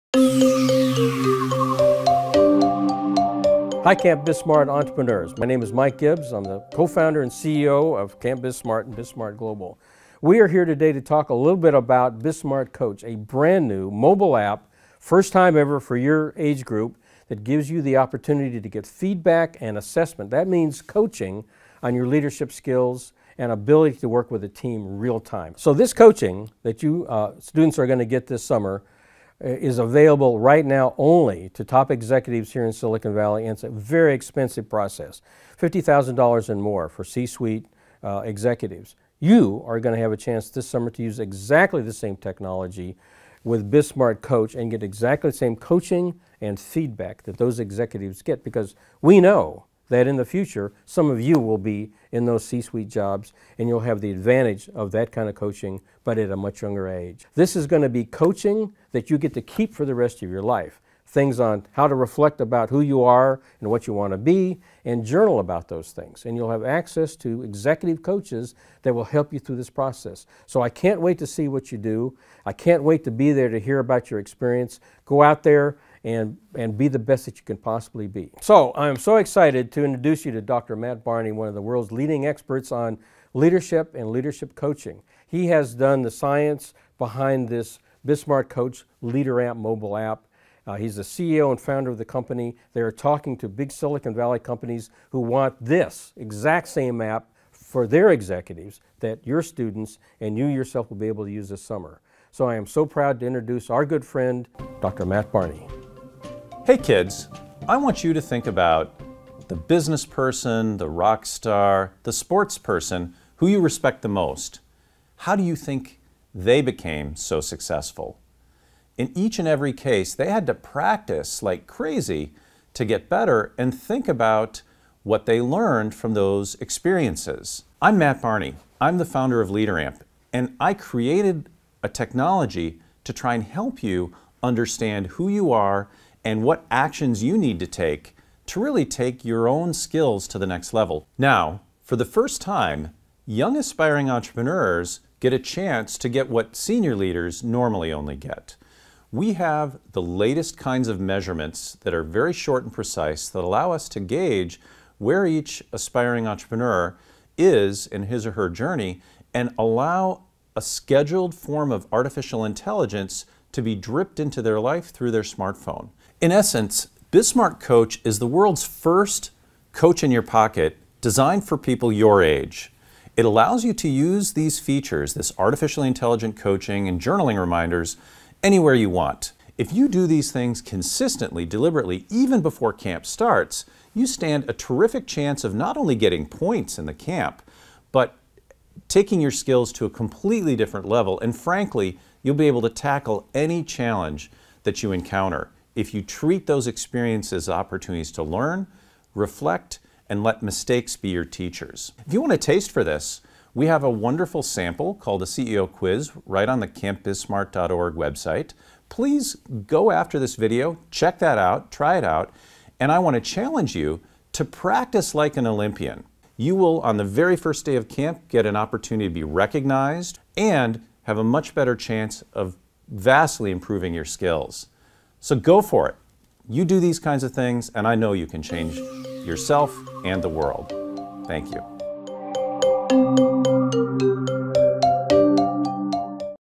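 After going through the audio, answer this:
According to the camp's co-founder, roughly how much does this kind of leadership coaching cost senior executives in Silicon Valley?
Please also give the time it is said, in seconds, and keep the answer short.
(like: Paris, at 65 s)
$50,000, at 35 s.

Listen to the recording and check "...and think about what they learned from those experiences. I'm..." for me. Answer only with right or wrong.
right.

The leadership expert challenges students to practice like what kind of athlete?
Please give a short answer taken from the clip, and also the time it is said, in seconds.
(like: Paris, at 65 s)
Olympian, at 215 s.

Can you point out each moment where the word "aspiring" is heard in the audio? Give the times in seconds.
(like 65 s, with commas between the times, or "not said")
143 s, 155 s.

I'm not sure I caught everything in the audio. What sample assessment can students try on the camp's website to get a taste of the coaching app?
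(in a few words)
CEO quiz.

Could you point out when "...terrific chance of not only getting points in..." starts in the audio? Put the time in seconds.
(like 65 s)
184 s.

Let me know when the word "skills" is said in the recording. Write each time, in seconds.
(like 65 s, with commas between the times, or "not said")
22 s, 139 s, 189 s, 224 s.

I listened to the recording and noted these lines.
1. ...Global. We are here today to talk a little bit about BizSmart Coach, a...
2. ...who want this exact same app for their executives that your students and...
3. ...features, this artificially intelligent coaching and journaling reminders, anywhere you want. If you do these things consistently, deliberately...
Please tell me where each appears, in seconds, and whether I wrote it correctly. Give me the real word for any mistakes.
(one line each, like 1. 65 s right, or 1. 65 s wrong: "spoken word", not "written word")
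1. 9 s right
2. 95 s right
3. 174 s right.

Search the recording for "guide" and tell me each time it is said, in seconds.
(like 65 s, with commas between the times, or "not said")
not said.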